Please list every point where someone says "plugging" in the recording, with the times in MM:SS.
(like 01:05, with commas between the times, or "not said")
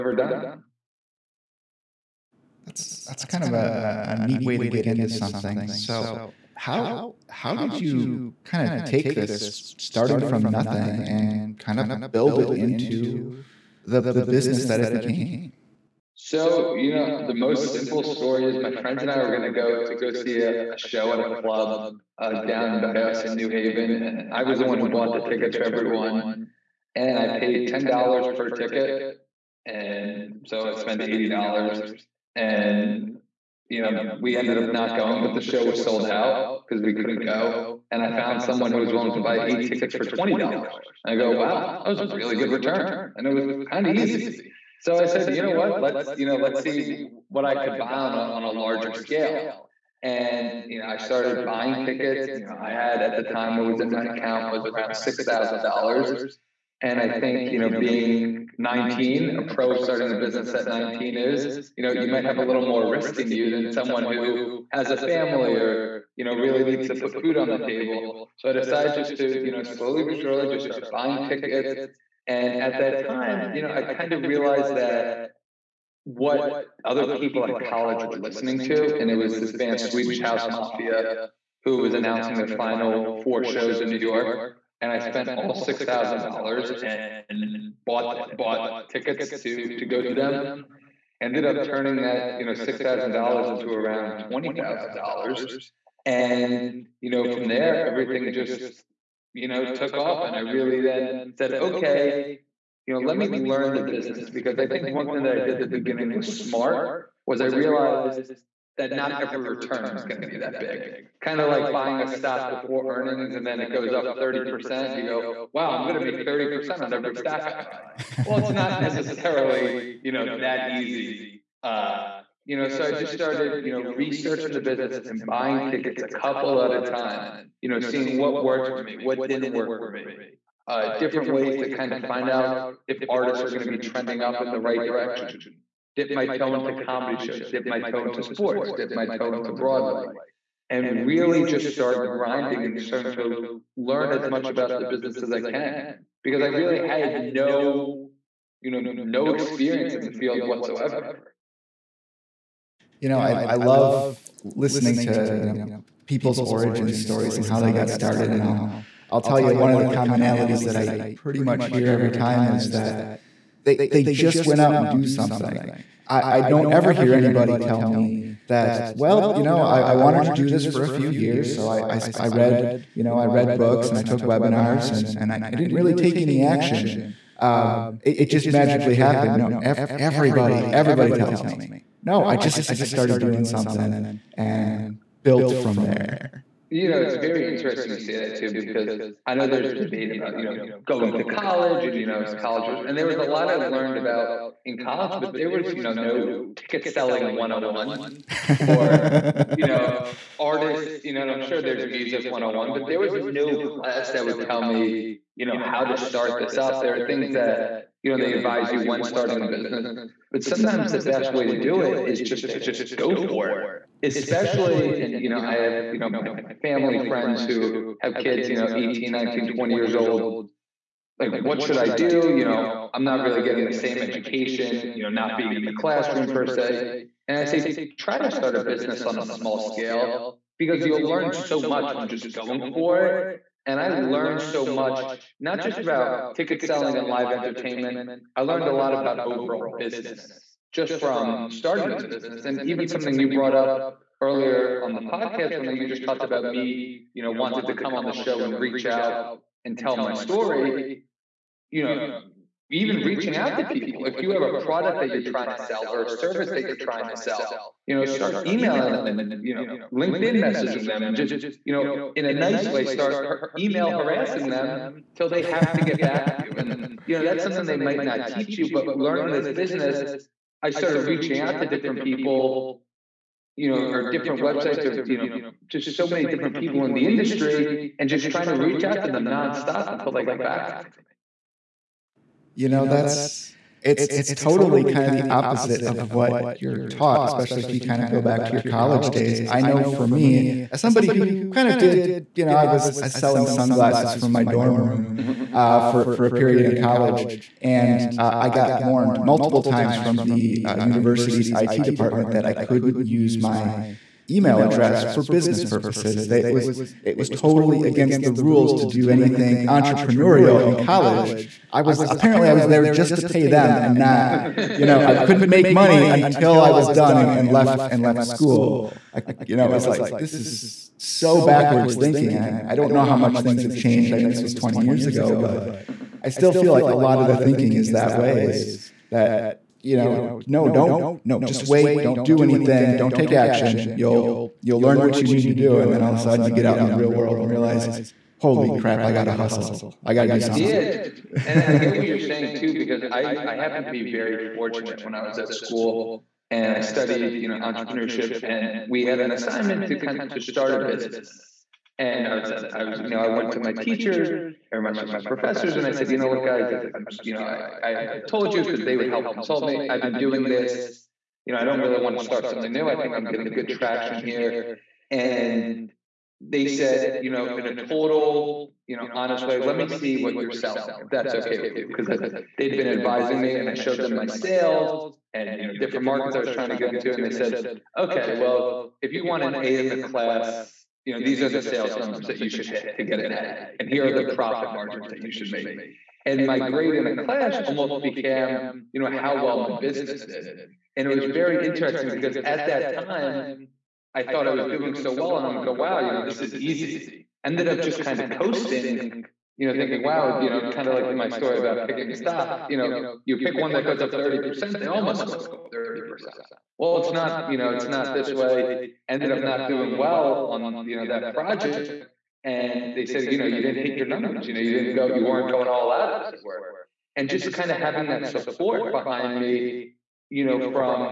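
not said.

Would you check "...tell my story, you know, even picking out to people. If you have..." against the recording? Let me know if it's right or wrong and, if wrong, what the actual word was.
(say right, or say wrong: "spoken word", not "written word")
wrong: "reaching", not "picking".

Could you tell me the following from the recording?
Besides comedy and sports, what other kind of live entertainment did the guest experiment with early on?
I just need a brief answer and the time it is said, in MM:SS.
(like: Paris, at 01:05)
Broadway, at 02:19.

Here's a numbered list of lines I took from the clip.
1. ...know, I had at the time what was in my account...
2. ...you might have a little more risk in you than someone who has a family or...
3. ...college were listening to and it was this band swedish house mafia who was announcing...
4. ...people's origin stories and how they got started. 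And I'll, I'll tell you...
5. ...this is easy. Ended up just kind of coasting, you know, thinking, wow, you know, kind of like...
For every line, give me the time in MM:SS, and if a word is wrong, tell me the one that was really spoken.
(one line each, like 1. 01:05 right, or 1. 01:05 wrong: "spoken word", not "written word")
1. 00:52 right
2. 01:01 right
3. 01:17 right
4. 02:36 right
5. 06:36 right.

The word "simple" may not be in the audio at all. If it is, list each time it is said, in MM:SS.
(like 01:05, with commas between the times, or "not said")
00:17.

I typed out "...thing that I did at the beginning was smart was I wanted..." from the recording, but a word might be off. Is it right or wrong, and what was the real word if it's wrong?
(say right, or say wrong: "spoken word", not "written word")
wrong: "realized", not "wanted".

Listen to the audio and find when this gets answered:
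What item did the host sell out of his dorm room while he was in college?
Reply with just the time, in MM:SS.
04:53.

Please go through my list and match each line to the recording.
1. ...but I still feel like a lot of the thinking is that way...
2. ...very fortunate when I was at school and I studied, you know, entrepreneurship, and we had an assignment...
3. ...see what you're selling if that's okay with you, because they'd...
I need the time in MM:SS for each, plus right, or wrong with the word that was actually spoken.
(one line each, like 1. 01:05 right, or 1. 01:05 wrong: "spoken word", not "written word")
1. 05:25 right
2. 05:44 right
3. 06:09 right.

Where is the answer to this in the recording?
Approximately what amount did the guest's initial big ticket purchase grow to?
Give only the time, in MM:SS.
01:34.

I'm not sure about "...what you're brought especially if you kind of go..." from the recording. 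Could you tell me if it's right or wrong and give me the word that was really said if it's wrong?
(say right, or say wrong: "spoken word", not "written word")
wrong: "taught", not "brought".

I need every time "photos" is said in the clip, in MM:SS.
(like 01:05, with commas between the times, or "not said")
not said.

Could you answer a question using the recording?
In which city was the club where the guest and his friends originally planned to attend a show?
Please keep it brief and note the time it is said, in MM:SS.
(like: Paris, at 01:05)
New Haven, at 00:23.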